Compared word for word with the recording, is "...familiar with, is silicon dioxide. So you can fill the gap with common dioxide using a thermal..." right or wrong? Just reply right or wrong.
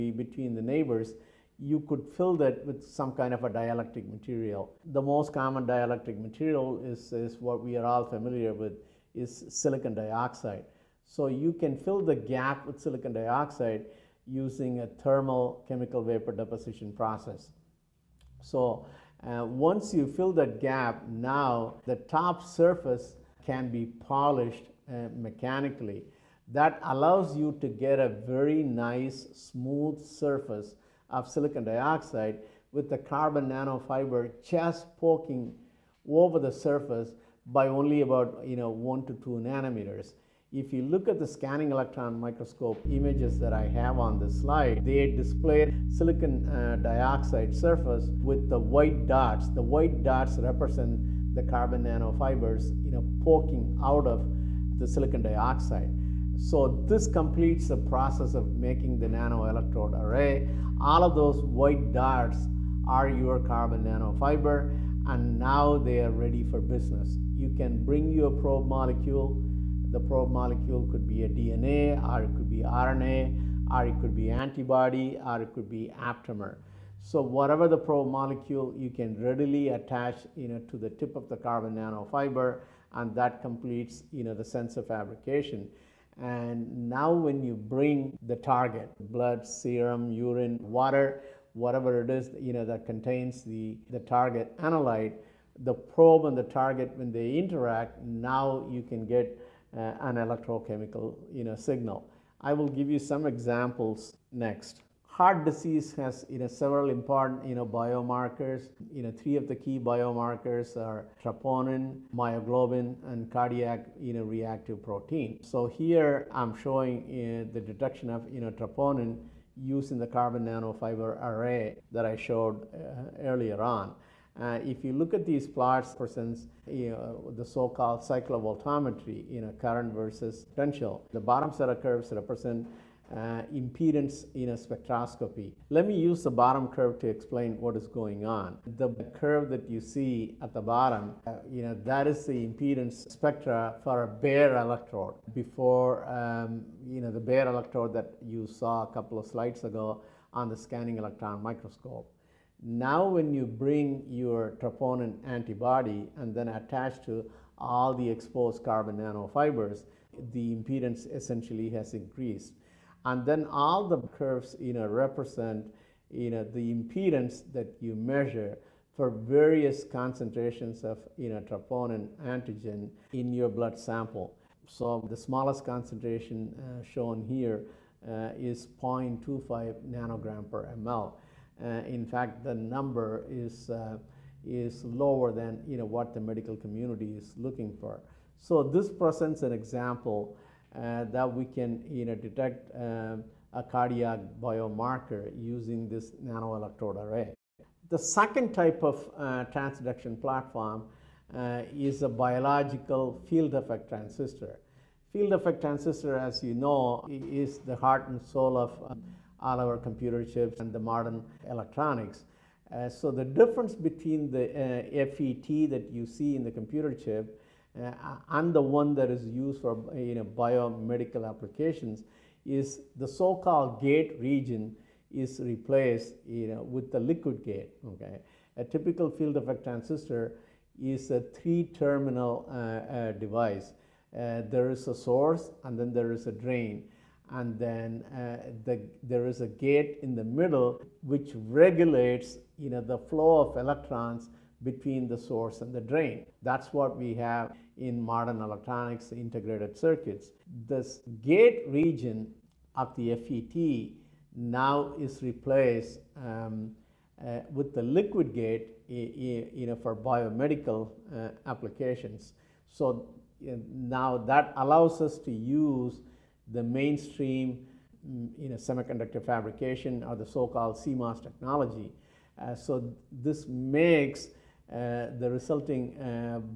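wrong.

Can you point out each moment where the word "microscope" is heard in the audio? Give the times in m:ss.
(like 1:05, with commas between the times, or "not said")
0:42, 2:31.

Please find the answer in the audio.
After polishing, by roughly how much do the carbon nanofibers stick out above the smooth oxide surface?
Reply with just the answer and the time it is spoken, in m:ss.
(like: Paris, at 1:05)
1 to 2 nanometers, at 0:38.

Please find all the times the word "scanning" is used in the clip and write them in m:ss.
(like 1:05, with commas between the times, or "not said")
0:41, 2:30.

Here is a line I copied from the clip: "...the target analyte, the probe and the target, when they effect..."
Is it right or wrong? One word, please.
wrong.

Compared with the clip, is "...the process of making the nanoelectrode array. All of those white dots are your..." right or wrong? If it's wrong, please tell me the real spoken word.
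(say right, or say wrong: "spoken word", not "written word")
right.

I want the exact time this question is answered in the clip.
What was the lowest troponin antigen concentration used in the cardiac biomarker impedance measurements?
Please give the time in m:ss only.
2:58.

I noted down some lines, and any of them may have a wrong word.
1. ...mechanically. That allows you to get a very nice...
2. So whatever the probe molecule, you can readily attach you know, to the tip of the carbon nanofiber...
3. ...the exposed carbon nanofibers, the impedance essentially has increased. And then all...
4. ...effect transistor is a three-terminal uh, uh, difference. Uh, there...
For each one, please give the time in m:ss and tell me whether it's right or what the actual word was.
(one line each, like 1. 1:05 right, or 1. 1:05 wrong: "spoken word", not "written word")
1. 0:25 right
2. 1:17 right
3. 2:37 right
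4. 3:49 wrong: "device", not "difference".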